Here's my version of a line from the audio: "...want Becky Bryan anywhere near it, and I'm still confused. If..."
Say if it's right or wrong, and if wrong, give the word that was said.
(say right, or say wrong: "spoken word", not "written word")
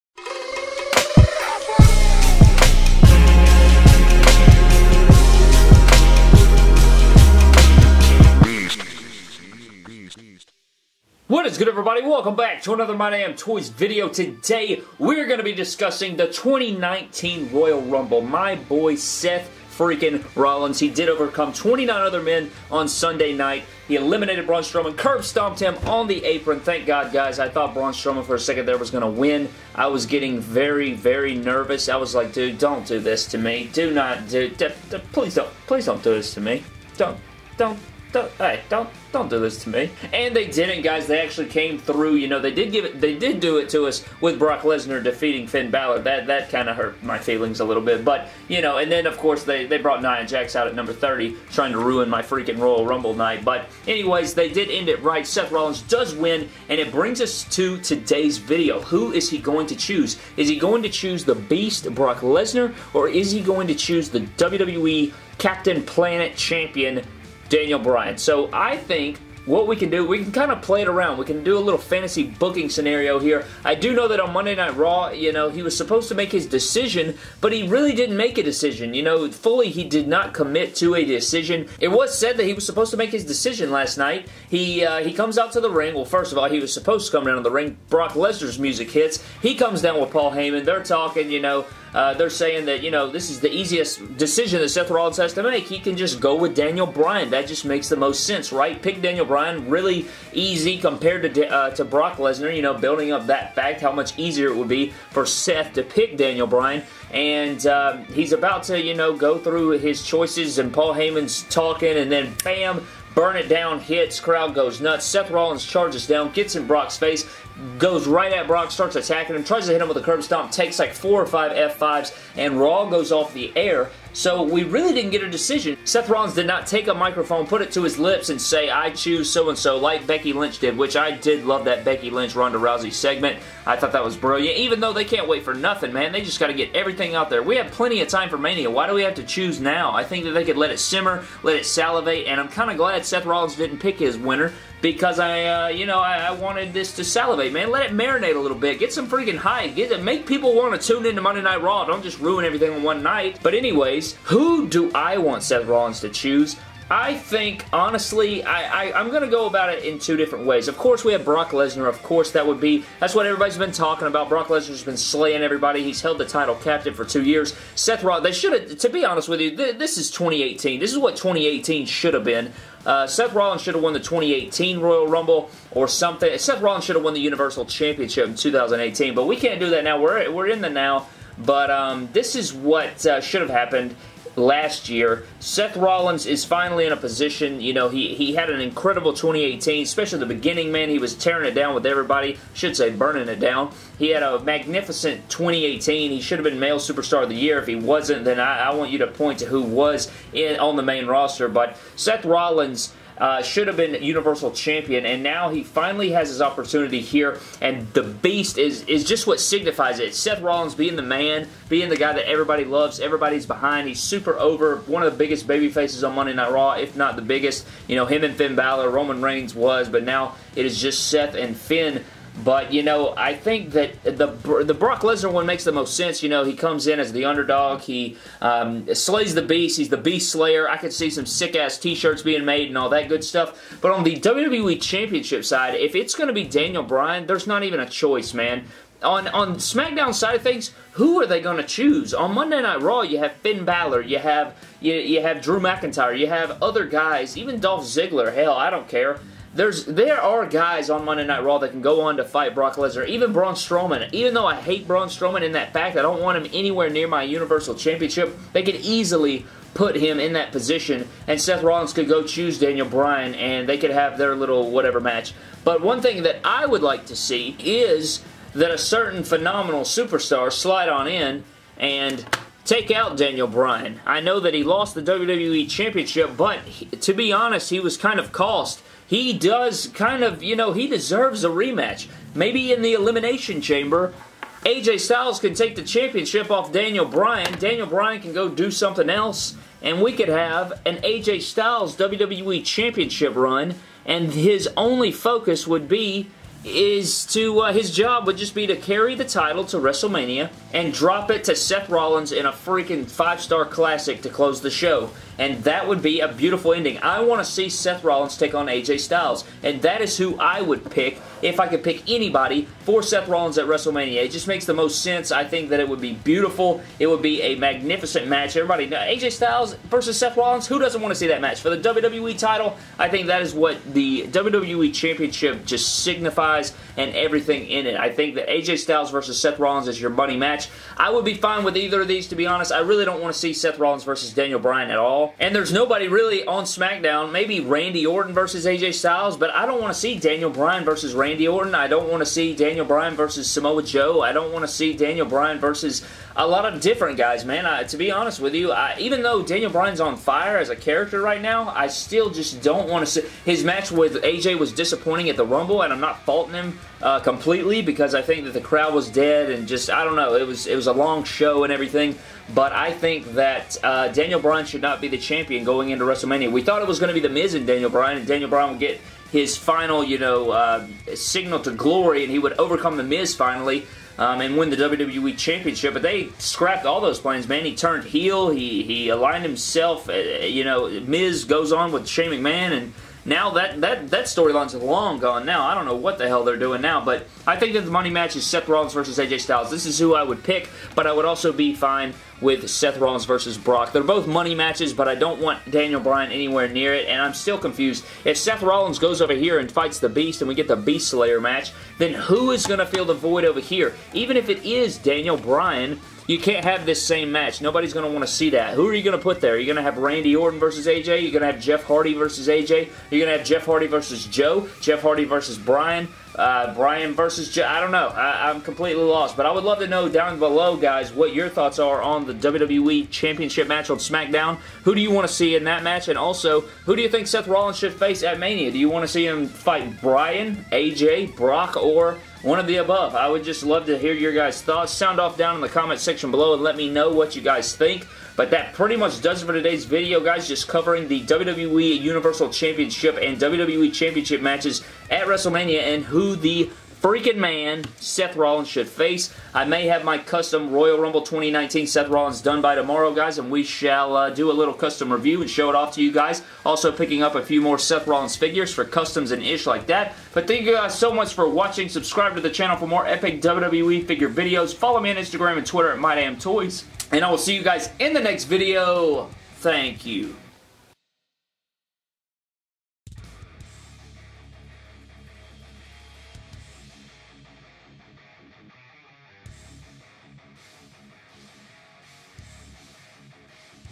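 wrong: "Daniel", not "Becky".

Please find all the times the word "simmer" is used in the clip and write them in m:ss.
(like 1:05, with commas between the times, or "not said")
2:20.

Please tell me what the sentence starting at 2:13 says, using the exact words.
I thought that was brilliant, even though they can't wait for nothing, man.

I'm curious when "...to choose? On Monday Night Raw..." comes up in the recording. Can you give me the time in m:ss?
4:01.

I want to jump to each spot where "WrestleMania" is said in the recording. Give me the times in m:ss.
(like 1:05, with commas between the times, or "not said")
4:59, 5:13, 6:06, 7:25.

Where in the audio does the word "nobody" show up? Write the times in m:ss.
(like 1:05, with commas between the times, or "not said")
5:35, 6:47.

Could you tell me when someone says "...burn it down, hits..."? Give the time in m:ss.
1:53.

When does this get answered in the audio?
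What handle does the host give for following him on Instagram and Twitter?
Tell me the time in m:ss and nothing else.
7:45.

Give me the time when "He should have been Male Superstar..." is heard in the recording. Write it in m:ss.
3:16.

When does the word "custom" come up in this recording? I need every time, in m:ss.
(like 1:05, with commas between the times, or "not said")
7:30, 7:34, 7:38.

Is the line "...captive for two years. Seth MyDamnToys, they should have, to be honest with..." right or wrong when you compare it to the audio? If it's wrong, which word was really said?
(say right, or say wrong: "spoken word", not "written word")
wrong: "Rollins", not "MyDamnToys".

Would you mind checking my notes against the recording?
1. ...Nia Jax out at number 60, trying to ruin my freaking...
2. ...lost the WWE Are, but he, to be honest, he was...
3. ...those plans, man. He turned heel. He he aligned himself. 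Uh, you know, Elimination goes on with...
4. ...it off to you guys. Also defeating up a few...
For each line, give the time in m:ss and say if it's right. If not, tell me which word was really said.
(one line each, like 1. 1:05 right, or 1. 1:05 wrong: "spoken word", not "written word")
1. 0:50 wrong: "30", not "60"
2. 4:34 wrong: "Championship", not "Are"
3. 6:17 wrong: "Miz", not "Elimination"
4. 7:35 wrong: "picking", not "defeating".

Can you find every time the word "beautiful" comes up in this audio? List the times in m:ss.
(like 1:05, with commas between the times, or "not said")
5:06, 5:16.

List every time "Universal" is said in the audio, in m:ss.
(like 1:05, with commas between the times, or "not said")
2:57, 3:24, 4:17, 7:22.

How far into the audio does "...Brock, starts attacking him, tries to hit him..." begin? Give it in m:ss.
1:58.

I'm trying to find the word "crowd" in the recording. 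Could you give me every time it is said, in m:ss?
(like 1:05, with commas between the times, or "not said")
1:54, 5:58.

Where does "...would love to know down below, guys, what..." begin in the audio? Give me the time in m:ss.
6:59.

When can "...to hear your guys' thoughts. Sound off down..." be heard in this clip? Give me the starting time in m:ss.
7:13.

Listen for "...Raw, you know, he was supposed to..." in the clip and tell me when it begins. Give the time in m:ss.
1:14.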